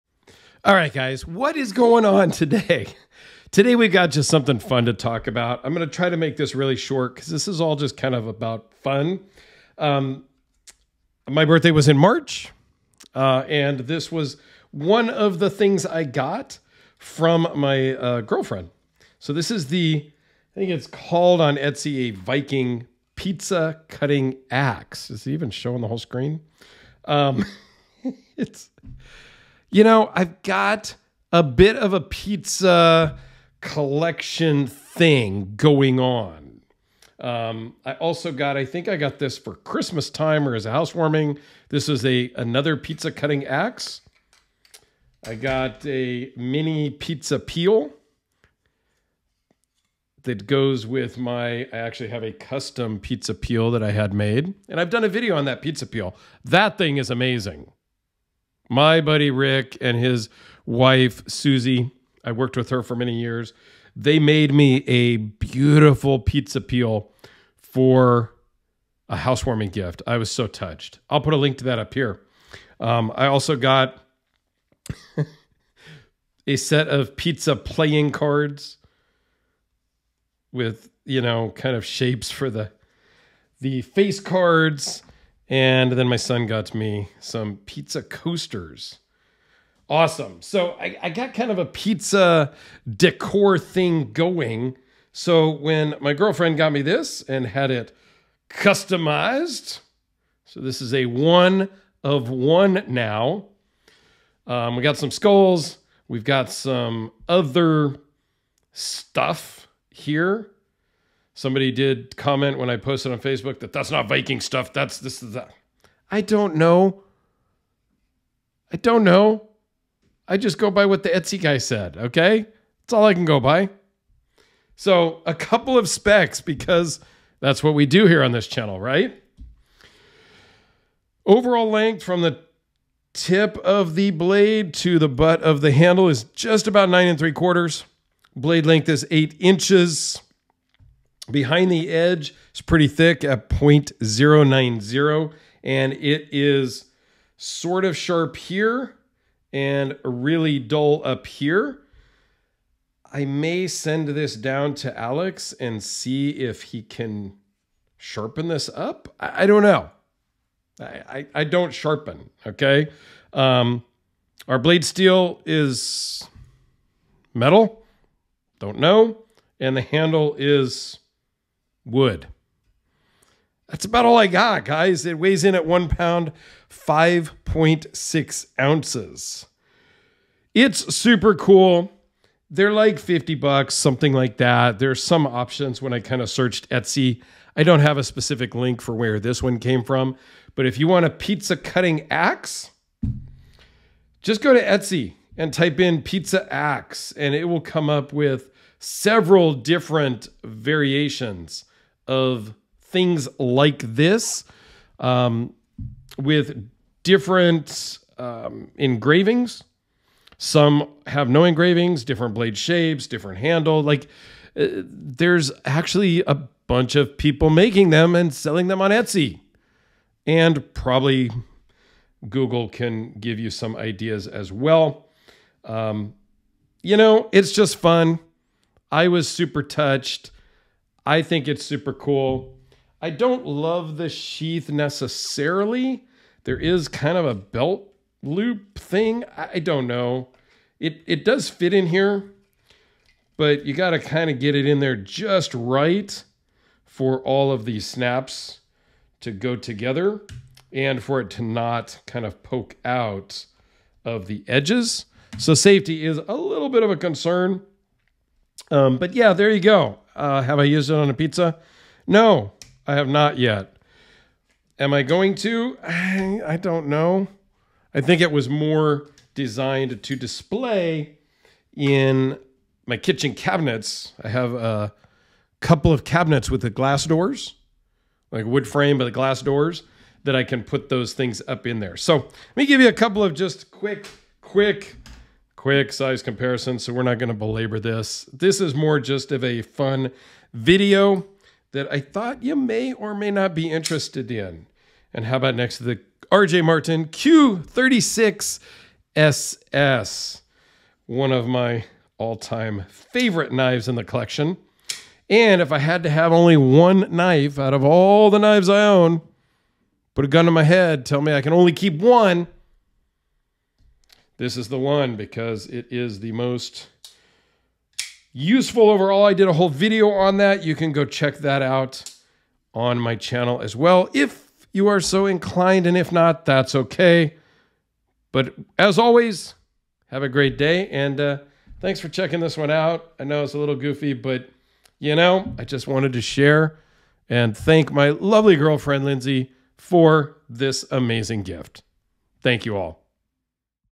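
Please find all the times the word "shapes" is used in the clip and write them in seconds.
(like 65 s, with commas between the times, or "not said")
81 s, 212 s.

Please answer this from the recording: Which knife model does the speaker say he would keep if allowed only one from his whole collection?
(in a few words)
RJ Martin Q36SS.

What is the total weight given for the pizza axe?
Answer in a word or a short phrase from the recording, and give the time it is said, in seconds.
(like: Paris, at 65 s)
1 pound 5.6 ounces, at 175 s.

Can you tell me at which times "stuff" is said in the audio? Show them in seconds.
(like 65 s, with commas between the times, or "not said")
108 s, 114 s.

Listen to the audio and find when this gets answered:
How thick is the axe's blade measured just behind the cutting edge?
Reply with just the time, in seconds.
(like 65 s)
143 s.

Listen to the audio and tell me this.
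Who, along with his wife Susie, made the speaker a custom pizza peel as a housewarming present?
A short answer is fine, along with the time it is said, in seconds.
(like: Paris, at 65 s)
Rick, at 59 s.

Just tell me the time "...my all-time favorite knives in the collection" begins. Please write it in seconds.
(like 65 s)
301 s.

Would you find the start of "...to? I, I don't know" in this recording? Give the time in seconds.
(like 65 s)
265 s.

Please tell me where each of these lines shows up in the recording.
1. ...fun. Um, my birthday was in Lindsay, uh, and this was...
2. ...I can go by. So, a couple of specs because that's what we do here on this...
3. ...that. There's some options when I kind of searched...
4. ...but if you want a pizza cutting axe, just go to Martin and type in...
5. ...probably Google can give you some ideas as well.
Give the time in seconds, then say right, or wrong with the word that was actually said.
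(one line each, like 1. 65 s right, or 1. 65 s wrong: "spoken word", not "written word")
1. 8 s wrong: "March", not "Lindsay"
2. 123 s right
3. 184 s right
4. 190 s wrong: "Etsy", not "Martin"
5. 220 s right.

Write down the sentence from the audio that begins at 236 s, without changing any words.
There is kind of a belt loop thing.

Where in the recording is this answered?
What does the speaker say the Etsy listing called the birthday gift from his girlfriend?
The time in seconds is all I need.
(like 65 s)
22 s.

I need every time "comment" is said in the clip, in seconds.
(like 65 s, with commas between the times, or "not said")
112 s.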